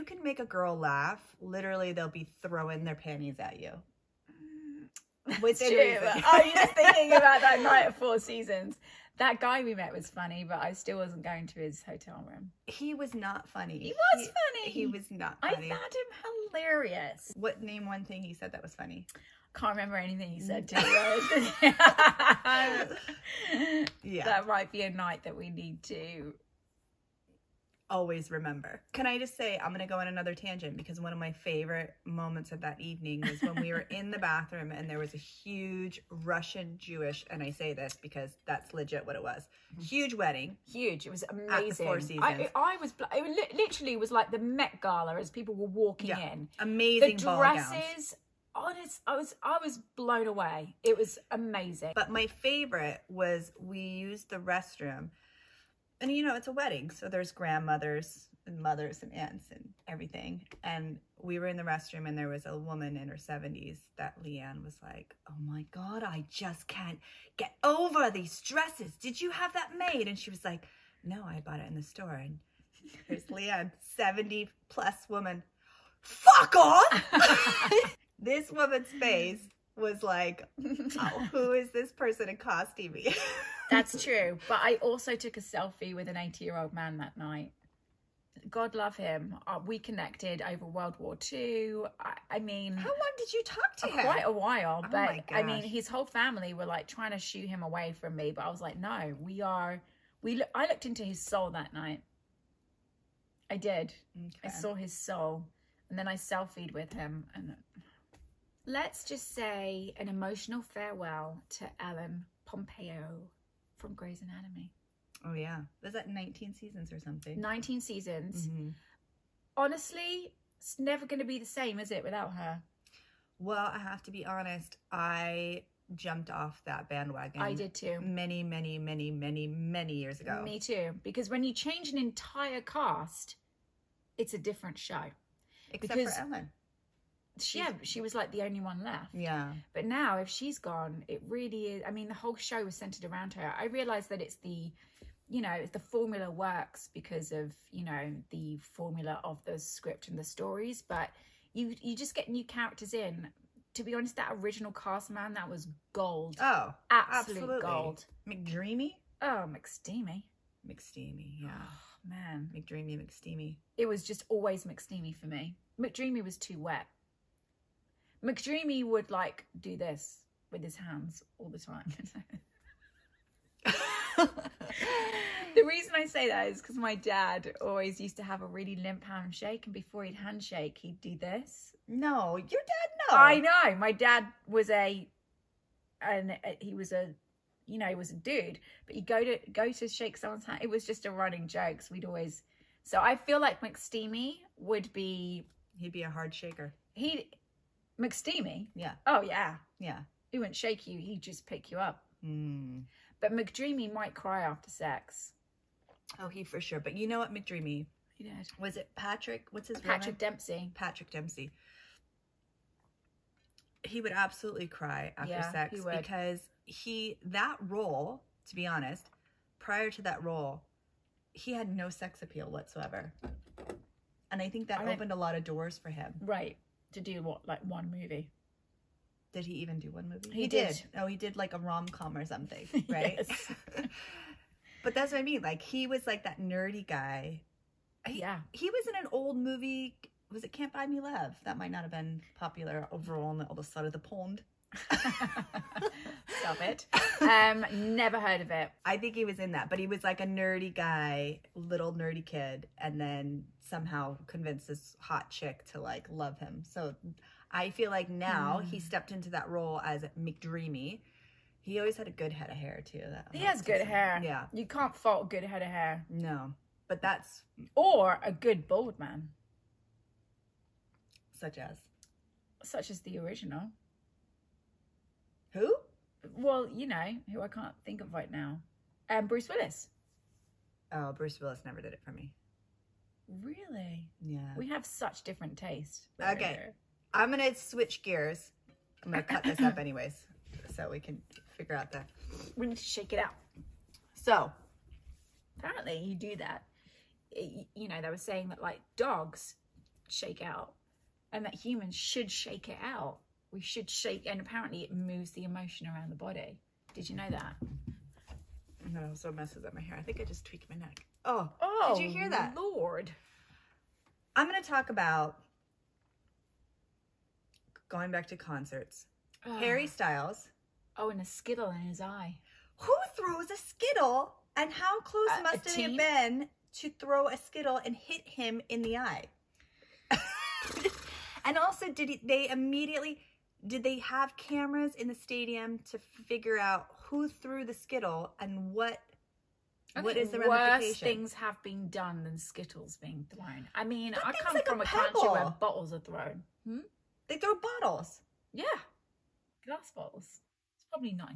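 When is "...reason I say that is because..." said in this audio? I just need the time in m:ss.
2:55.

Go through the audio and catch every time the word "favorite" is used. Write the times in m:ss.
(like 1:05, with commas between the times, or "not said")
0:31, 0:52.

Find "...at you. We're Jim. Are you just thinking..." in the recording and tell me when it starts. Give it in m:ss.
0:03.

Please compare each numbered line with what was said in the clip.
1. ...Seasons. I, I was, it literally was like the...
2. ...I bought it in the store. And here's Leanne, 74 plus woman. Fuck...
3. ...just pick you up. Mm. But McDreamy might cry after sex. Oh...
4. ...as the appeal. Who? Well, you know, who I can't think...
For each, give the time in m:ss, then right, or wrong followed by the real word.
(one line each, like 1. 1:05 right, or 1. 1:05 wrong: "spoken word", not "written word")
1. 0:41 right
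2. 1:11 wrong: "70", not "74"
3. 3:21 right
4. 4:32 wrong: "original", not "appeal".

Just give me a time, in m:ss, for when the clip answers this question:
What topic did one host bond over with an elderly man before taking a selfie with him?
1:30.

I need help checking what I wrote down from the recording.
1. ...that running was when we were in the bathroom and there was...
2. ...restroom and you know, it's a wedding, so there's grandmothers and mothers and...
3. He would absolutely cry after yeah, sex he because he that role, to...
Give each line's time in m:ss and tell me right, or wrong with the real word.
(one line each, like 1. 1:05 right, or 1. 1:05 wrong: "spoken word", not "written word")
1. 0:32 wrong: "evening", not "running"
2. 0:54 right
3. 3:33 right.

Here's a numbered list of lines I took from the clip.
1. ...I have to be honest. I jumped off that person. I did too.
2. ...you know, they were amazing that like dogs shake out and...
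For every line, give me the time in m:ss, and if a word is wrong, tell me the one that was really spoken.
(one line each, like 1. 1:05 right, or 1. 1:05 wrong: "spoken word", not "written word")
1. 2:03 wrong: "bandwagon", not "person"
2. 4:57 wrong: "saying", not "amazing".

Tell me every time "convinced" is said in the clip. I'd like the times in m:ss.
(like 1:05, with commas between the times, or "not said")
4:14.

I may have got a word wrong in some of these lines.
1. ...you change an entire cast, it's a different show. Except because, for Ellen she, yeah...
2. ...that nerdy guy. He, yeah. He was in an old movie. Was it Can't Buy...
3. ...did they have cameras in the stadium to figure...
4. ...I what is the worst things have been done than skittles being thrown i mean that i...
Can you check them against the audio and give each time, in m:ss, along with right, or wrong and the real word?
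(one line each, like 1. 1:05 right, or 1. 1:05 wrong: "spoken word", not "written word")
1. 2:11 right
2. 3:56 right
3. 5:33 right
4. 5:39 right.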